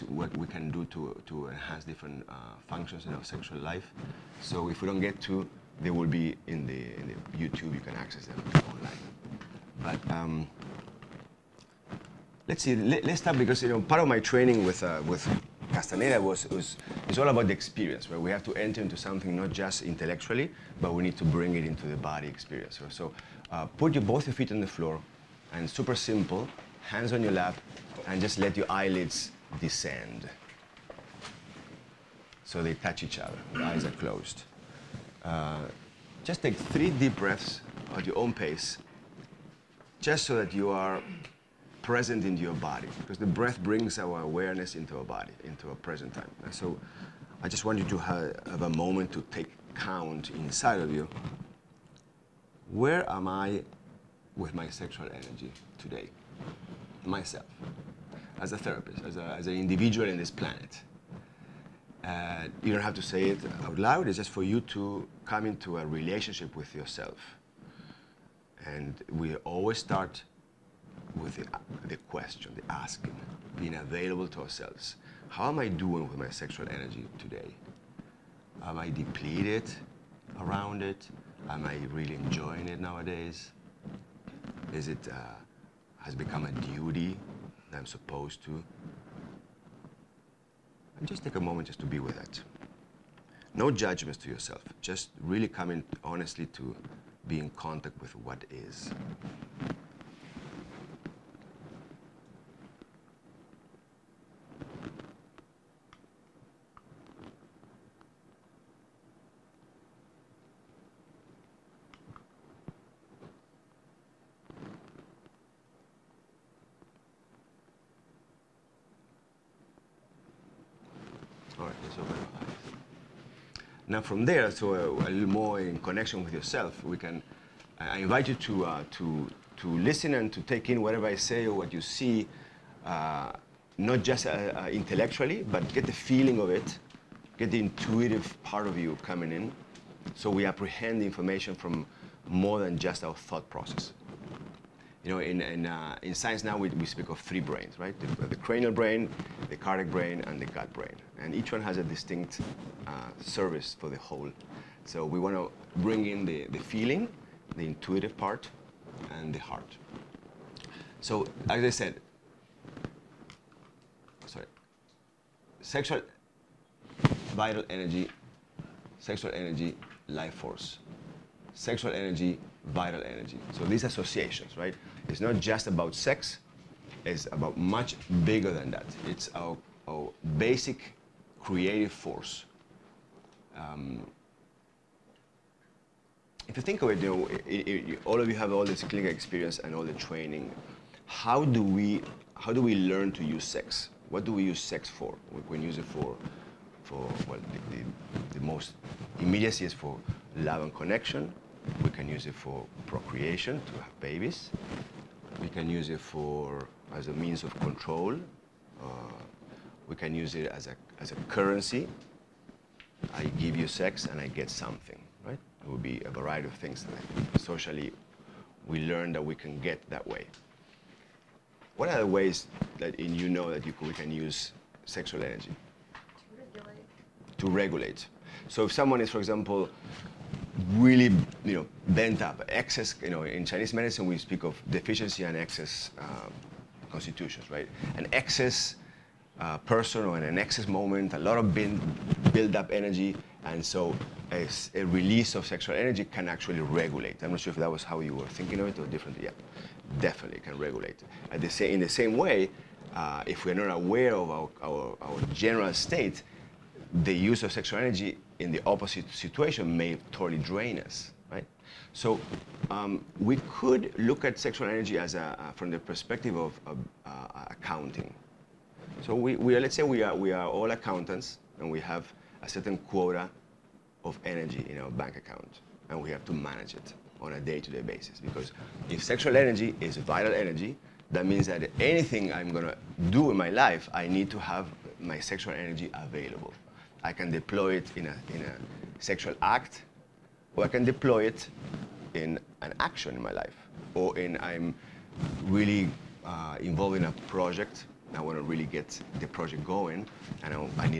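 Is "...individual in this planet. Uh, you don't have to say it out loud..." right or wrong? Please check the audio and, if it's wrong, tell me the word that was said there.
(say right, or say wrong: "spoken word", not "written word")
right.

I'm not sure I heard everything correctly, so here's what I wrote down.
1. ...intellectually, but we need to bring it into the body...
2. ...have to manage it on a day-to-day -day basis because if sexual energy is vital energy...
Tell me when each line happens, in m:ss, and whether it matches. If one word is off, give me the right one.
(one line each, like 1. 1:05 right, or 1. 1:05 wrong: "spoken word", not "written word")
1. 0:19 right
2. 4:36 right.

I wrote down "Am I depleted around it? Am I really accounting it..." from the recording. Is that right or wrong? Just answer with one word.
wrong.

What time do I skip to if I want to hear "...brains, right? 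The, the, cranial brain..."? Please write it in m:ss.
2:27.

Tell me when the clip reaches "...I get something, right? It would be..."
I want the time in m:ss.
3:34.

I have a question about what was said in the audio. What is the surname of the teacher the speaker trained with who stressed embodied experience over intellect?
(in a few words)
Castaneda.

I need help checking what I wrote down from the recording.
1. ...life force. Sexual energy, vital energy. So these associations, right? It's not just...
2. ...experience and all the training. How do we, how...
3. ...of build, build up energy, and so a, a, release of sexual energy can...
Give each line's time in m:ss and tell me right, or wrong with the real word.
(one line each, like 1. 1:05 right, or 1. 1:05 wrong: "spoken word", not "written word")
1. 2:50 right
2. 3:09 right
3. 4:01 right.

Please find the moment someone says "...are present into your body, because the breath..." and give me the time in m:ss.
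0:40.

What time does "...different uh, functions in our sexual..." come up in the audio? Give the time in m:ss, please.
0:01.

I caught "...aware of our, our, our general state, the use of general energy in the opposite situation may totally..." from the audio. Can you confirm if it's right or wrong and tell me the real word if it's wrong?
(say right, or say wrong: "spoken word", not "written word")
wrong: "sexual", not "general".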